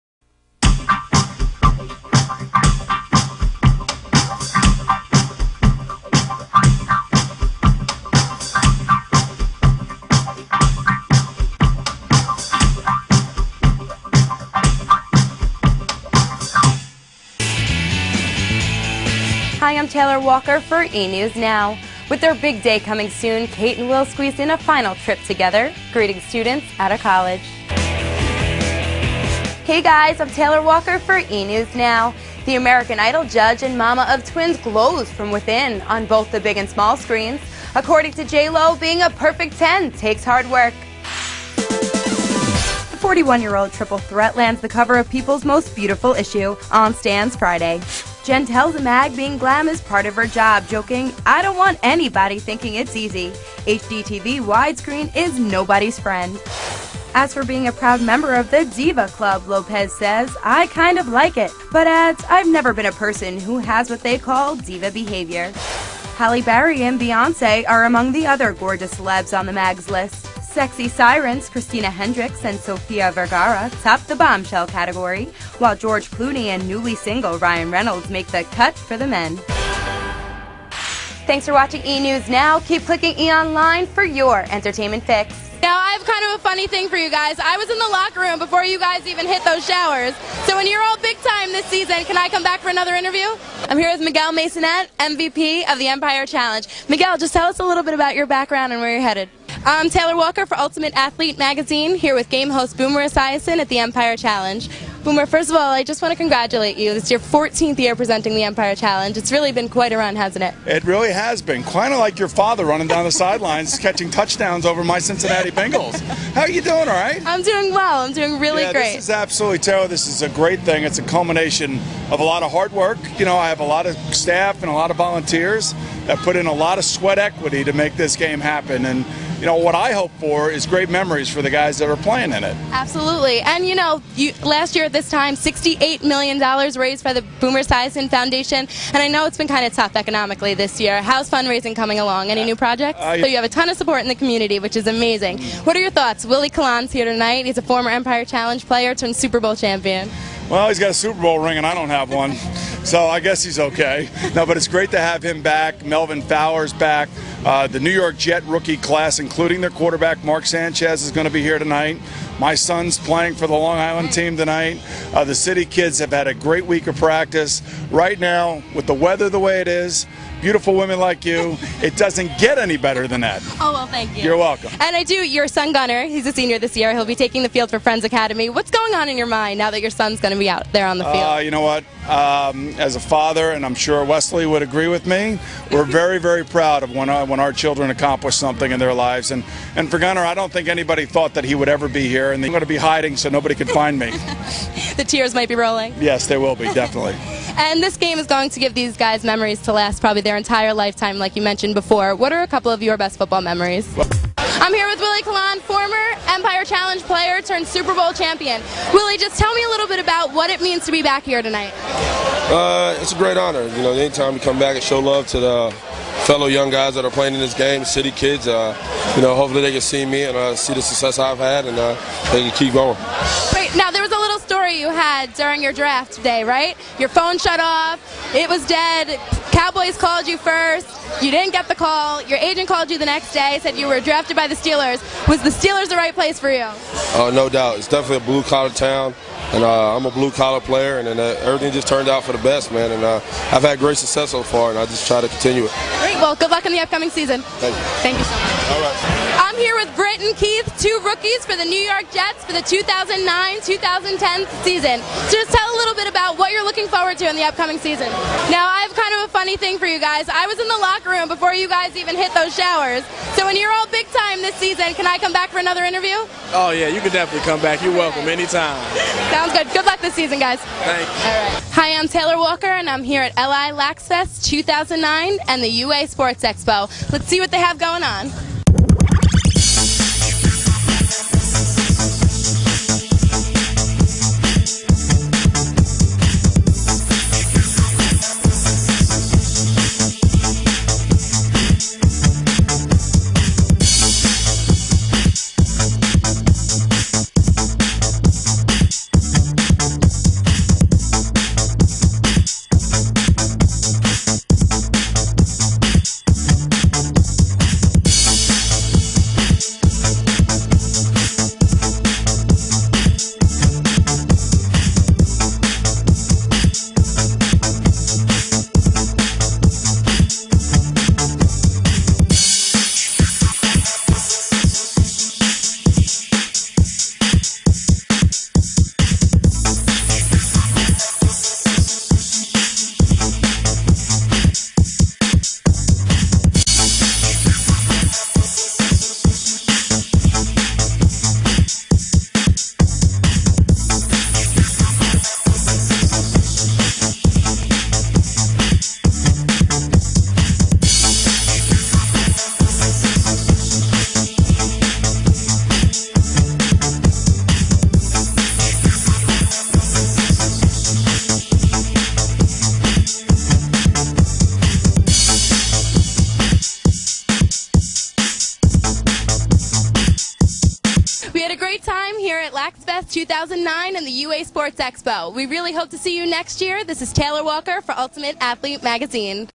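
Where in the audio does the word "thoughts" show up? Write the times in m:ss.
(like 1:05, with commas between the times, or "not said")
2:25, 3:11.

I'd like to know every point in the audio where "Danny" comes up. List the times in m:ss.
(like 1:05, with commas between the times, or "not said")
not said.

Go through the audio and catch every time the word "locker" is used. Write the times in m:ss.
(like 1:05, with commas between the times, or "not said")
1:27, 4:20.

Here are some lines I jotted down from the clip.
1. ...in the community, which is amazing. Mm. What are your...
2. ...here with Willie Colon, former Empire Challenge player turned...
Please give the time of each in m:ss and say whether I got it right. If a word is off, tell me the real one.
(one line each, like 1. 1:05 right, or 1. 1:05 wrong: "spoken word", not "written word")
1. 2:24 right
2. 3:24 right.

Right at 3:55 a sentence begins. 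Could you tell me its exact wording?
Was the Steelers the right place for you?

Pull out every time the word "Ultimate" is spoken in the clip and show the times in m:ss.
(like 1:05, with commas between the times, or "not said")
1:40, 6:17.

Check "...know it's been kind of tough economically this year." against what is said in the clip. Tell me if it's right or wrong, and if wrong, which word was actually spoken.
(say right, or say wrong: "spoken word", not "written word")
right.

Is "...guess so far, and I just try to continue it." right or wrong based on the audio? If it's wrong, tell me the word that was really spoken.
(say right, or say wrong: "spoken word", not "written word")
wrong: "success", not "guess".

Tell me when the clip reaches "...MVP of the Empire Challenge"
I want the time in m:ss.
1:34.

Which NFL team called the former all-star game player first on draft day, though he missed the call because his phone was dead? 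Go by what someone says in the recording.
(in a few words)
Cowboys.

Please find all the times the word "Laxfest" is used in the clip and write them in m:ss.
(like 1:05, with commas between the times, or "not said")
4:33, 6:12.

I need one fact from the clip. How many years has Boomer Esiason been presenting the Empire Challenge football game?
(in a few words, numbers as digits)
14.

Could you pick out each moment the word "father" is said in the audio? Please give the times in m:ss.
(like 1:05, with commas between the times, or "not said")
1:52, 3:02.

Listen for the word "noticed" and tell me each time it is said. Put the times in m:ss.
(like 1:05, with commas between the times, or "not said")
not said.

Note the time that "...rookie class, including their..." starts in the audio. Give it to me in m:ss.
2:38.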